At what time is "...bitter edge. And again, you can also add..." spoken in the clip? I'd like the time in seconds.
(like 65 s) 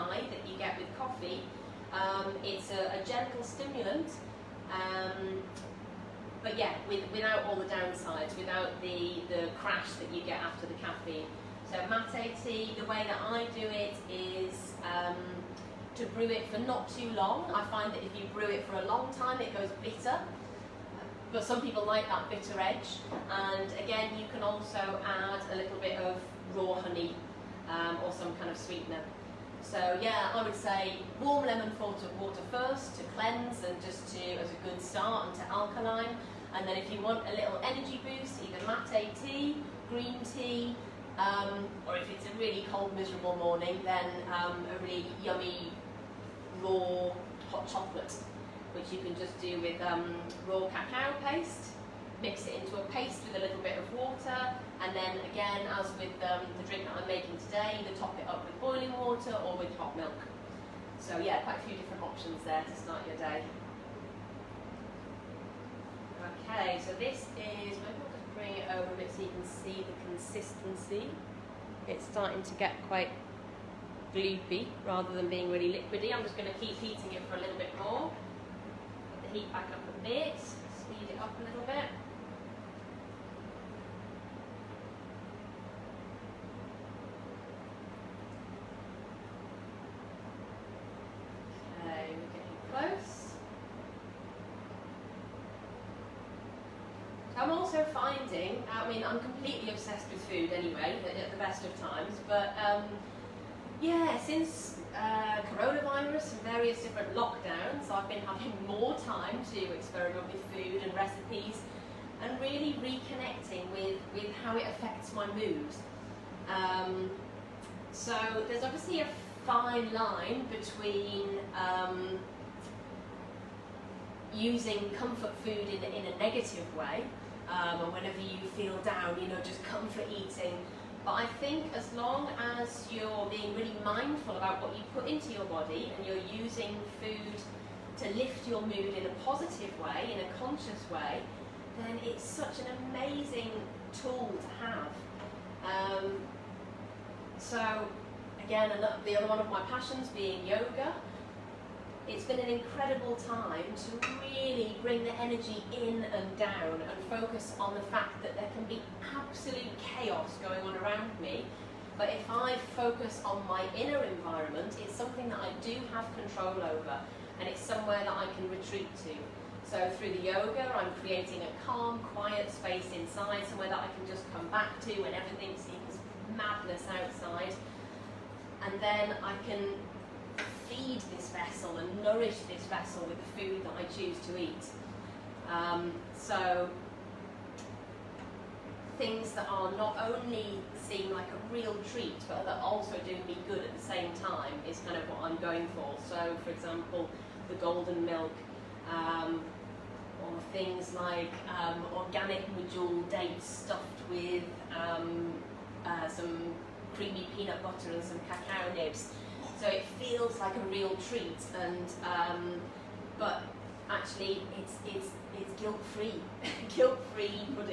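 22 s.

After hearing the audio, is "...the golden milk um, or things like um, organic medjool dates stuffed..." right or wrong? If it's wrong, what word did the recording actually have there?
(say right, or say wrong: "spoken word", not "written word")
right.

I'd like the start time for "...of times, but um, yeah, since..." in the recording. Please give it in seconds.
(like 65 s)
101 s.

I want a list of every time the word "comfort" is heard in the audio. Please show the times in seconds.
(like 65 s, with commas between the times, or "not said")
124 s, 129 s.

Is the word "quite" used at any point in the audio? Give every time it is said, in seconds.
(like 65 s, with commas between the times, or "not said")
61 s, 72 s.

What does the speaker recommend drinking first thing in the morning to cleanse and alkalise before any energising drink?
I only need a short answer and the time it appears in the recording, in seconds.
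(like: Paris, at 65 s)
warm lemon water, at 31 s.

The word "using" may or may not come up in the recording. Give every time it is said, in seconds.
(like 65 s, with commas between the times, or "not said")
124 s, 136 s.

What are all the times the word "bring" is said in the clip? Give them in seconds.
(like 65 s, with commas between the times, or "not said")
68 s, 154 s.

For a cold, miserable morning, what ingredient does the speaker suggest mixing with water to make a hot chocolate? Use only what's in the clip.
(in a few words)
raw cacao paste.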